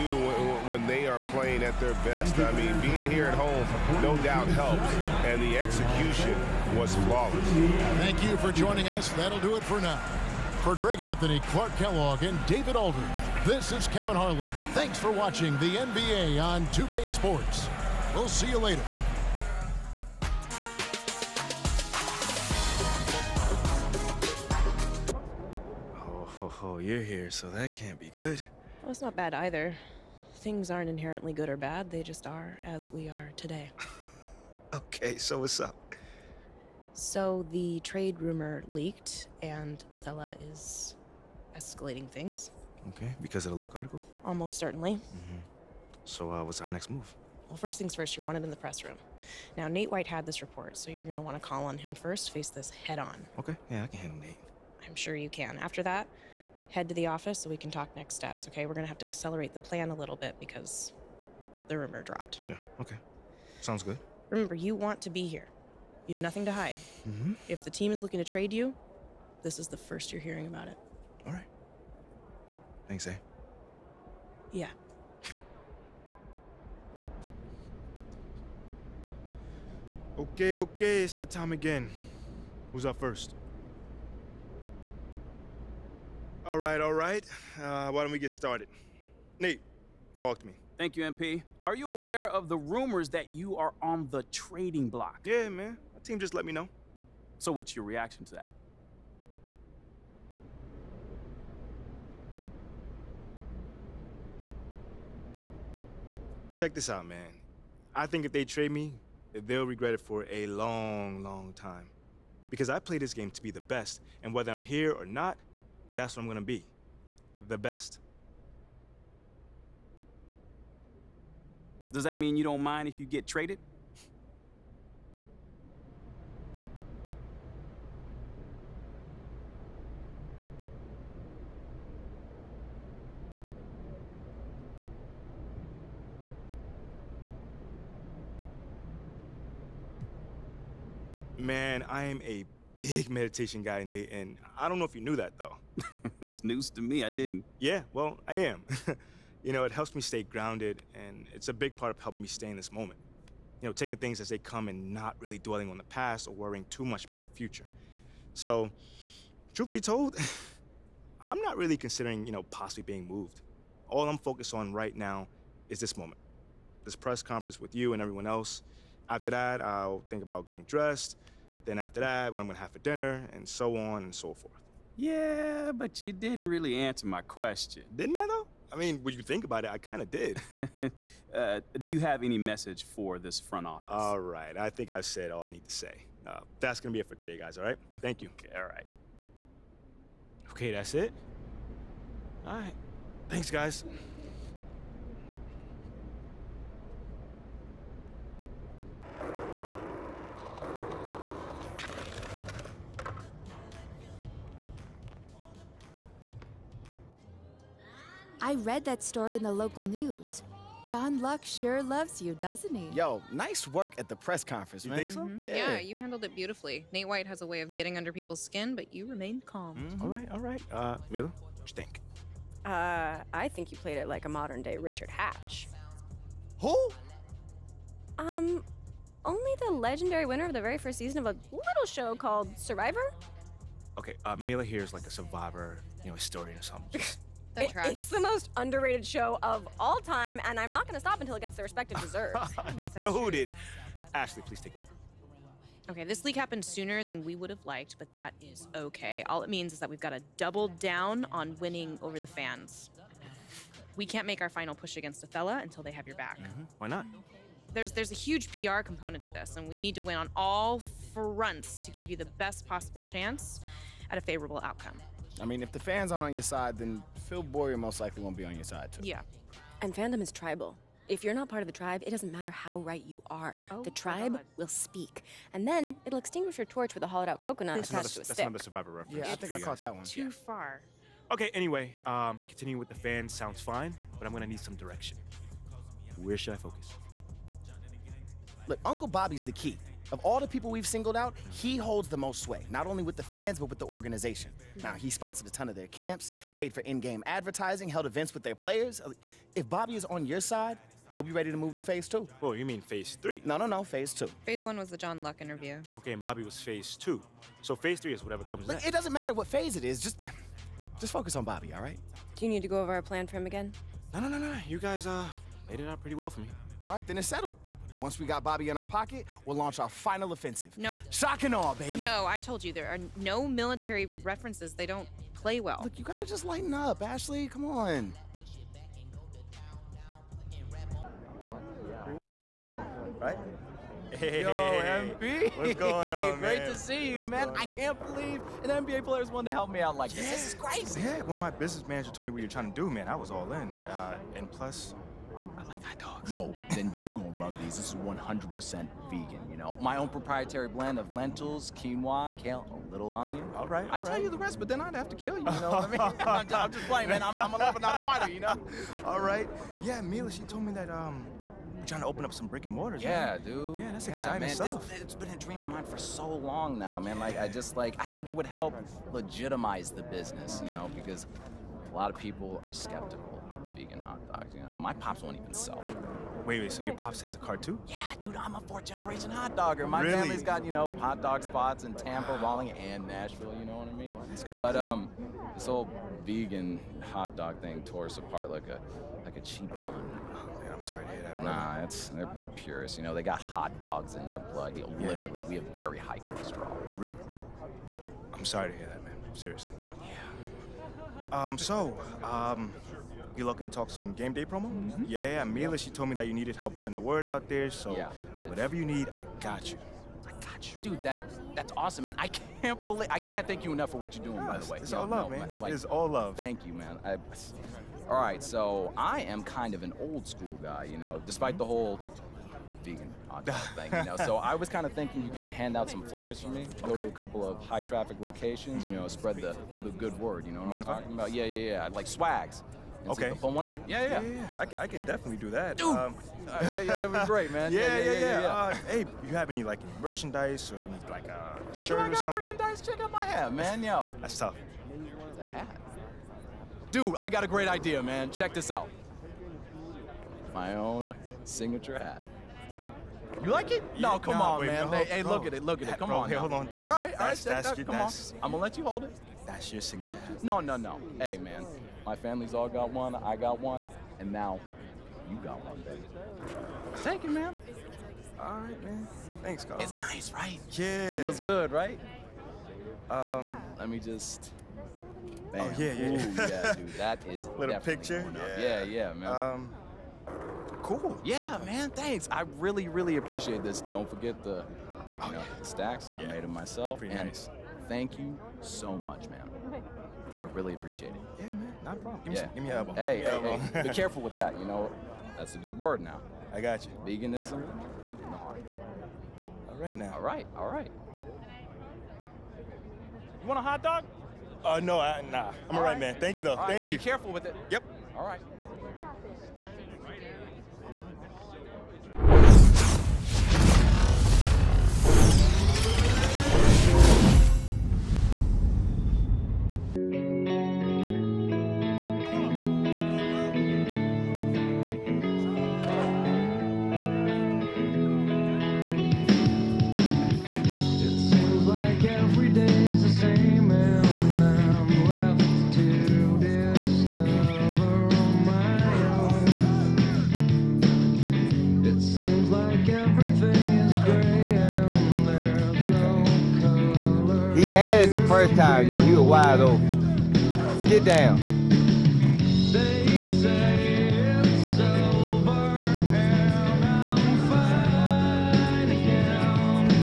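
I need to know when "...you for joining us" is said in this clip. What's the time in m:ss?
0:08.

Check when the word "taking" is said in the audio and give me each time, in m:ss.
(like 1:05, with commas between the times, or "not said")
2:33.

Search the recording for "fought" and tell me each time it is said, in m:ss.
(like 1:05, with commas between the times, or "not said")
not said.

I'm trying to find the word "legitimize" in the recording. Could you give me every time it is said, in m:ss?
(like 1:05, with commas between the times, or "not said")
6:09.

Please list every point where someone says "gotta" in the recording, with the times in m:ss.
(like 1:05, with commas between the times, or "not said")
5:26.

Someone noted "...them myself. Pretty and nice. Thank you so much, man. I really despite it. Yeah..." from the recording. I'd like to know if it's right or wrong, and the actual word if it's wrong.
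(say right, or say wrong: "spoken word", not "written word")
wrong: "appreciate", not "despite".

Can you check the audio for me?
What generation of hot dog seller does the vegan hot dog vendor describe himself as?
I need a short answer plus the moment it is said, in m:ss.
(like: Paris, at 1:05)
fourth generation, at 6:18.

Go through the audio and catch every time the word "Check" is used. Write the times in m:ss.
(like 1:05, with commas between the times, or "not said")
1:46, 7:22, 7:28.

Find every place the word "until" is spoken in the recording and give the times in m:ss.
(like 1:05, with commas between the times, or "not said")
4:01, 4:15.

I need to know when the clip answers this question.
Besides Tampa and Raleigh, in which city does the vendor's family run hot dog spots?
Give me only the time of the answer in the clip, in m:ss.
6:23.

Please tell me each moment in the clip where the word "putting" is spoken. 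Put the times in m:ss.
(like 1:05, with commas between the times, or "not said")
6:46.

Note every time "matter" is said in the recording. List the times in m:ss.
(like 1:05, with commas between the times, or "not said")
4:32, 5:09.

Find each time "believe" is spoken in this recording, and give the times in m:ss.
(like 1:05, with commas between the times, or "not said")
5:38, 6:52.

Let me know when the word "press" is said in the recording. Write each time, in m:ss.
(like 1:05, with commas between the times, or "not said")
0:48, 2:46, 3:34.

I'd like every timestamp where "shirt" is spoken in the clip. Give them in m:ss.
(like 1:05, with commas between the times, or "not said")
7:21.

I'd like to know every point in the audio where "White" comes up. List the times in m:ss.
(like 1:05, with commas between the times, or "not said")
0:49, 3:37.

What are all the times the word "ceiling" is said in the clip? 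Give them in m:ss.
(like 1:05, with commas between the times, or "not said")
not said.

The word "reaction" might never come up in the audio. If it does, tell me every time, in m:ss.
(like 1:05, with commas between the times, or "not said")
1:37.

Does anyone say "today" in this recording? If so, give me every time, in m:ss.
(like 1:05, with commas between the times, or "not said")
0:33, 3:07.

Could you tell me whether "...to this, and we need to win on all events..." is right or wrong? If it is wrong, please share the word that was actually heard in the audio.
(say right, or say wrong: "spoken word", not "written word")
wrong: "fronts", not "events".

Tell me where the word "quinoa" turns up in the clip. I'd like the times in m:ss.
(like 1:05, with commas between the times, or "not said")
5:51.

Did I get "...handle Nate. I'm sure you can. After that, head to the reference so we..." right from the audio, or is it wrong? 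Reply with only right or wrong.
wrong.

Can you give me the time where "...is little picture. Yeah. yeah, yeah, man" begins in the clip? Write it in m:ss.
7:57.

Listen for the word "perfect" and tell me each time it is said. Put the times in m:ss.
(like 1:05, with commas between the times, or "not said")
not said.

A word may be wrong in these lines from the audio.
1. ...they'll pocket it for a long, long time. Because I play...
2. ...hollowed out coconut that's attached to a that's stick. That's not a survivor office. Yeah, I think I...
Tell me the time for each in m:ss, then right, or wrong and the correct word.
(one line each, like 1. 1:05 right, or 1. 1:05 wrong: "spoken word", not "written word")
1. 1:49 wrong: "regret", not "pocket"
2. 4:37 wrong: "reference", not "office".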